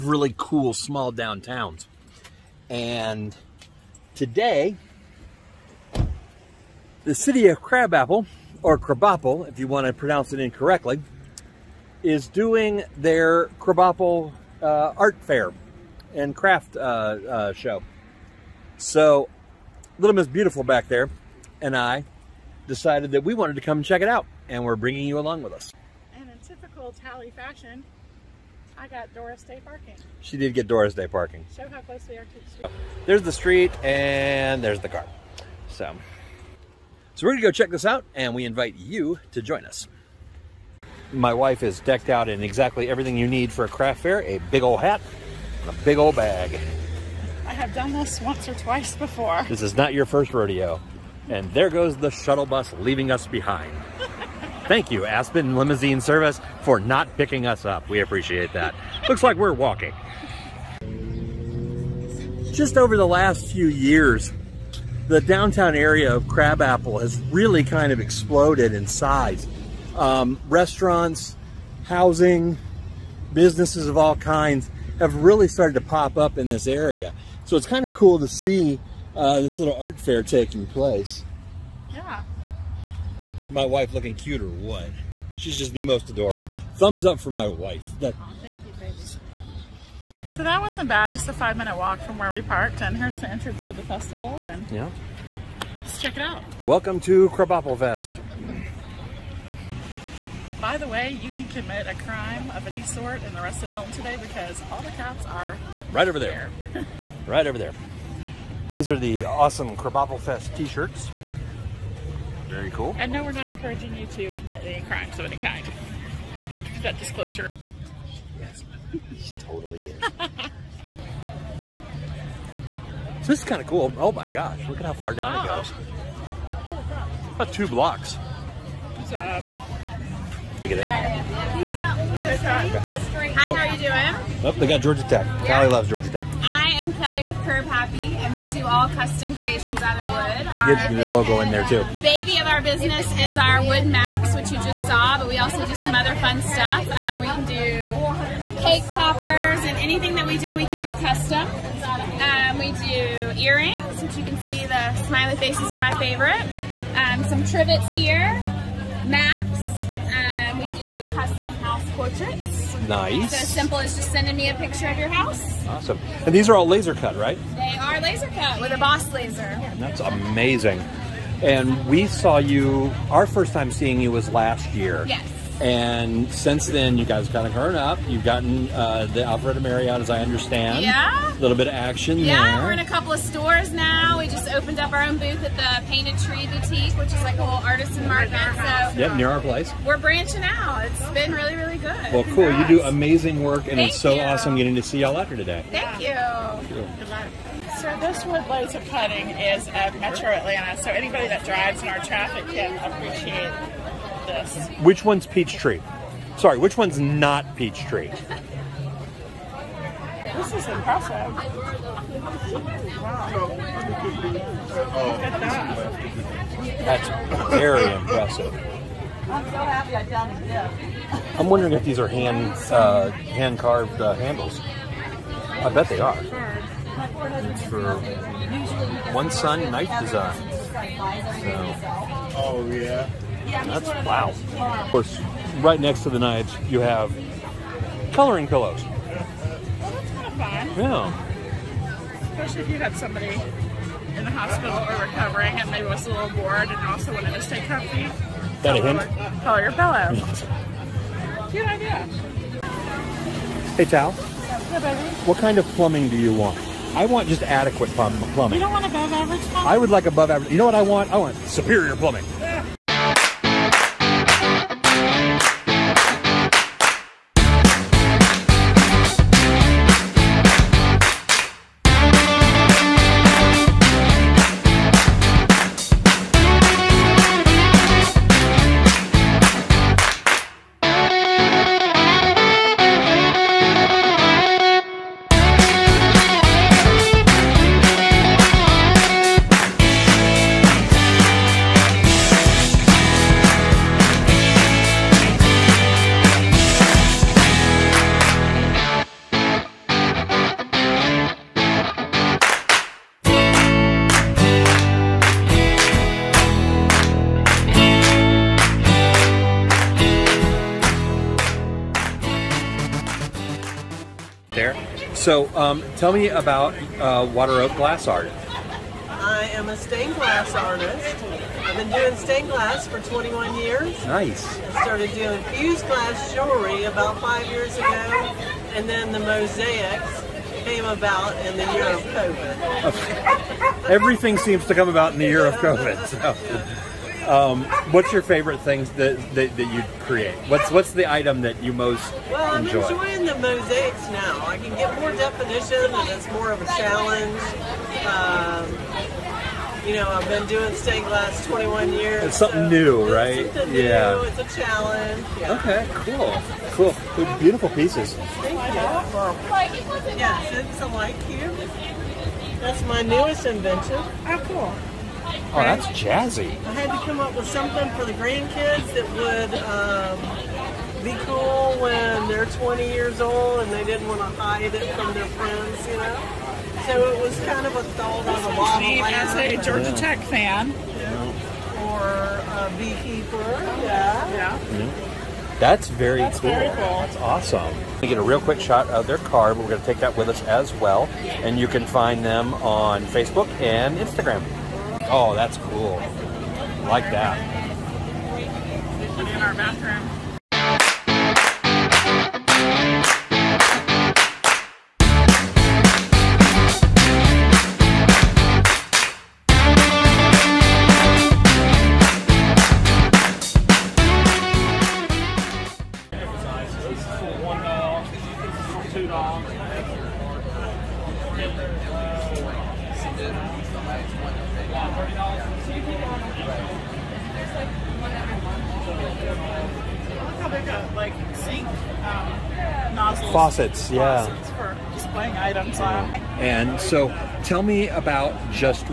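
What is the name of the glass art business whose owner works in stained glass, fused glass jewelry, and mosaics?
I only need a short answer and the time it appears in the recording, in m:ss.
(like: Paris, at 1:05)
Water Oak Glass Art, at 5:17.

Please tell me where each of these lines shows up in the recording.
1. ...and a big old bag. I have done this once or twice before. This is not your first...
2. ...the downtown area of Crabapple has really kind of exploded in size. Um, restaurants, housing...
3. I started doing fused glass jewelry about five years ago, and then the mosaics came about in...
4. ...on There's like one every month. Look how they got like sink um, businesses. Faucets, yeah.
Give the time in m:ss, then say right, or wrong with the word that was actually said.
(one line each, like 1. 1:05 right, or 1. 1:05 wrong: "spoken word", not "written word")
1. 0:45 right
2. 1:05 right
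3. 5:24 right
4. 7:06 wrong: "nozzles", not "businesses".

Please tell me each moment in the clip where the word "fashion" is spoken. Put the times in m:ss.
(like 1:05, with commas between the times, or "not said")
0:27.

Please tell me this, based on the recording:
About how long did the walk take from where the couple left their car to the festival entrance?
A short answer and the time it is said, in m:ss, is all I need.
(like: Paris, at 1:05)
5 minutes, at 1:31.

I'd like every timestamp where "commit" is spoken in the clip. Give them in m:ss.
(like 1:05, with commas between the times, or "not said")
1:41, 1:54.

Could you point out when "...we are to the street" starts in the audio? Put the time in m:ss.
0:32.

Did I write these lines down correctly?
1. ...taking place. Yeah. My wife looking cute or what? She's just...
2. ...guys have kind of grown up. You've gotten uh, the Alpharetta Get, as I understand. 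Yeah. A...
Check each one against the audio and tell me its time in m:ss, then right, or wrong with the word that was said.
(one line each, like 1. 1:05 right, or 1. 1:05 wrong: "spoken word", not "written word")
1. 1:20 right
2. 2:57 wrong: "Marriott", not "Get".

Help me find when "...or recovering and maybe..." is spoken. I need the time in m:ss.
4:04.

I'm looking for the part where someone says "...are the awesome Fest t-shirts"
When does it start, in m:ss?
1:48.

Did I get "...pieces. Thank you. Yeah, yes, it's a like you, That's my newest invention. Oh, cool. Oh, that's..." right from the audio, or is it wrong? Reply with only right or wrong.
right.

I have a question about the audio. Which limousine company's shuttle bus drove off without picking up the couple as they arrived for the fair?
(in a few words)
Aspen Limousine Service.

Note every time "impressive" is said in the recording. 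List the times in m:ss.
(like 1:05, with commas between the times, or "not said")
3:30, 3:37.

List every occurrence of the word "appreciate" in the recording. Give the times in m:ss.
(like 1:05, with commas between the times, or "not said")
0:58, 3:22.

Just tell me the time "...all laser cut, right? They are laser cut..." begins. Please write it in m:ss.
2:46.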